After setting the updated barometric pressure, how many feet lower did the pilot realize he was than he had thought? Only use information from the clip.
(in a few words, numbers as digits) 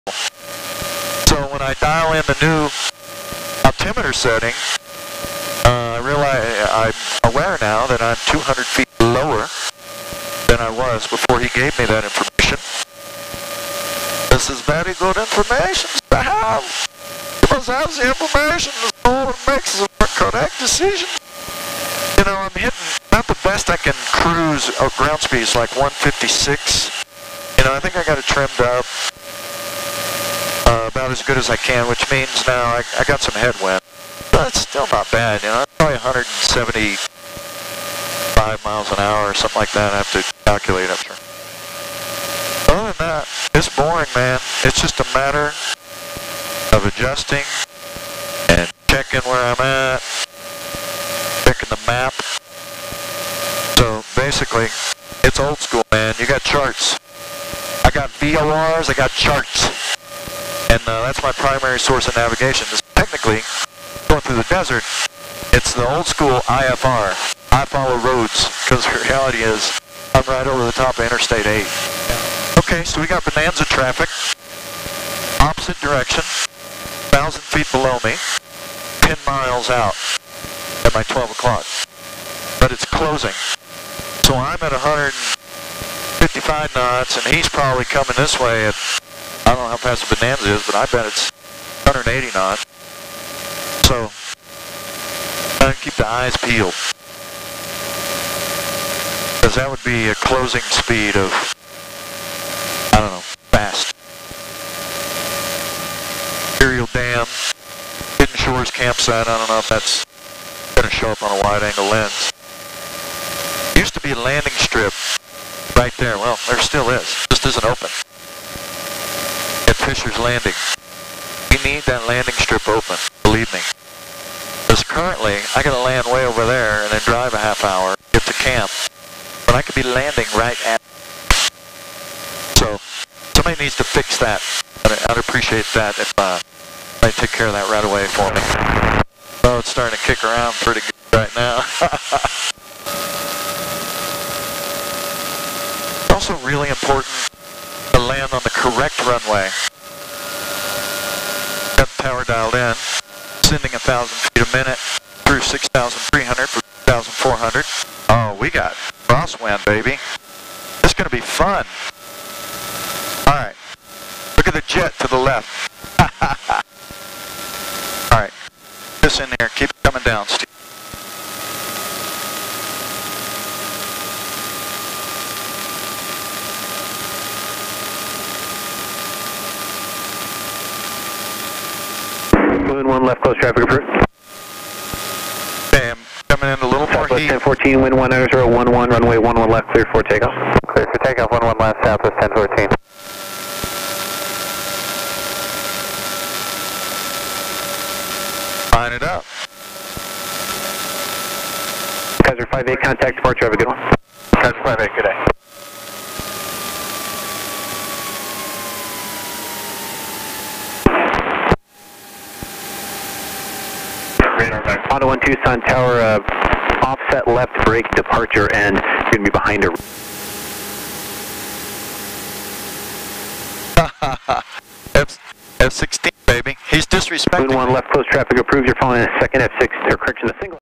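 200 feet.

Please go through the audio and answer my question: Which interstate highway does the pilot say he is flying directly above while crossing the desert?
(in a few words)
Interstate 8.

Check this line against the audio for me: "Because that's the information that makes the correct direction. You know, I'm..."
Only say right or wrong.
wrong.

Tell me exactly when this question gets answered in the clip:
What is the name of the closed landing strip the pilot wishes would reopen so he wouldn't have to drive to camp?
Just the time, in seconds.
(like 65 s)
119 s.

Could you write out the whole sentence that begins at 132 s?
So, somebody needs to fix that.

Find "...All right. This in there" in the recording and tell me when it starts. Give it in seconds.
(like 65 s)
168 s.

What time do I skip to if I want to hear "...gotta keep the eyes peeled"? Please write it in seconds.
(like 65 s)
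95 s.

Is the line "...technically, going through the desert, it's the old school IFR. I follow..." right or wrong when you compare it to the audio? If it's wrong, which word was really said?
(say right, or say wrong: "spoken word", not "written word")
right.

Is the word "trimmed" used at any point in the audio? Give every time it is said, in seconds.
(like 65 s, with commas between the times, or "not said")
28 s.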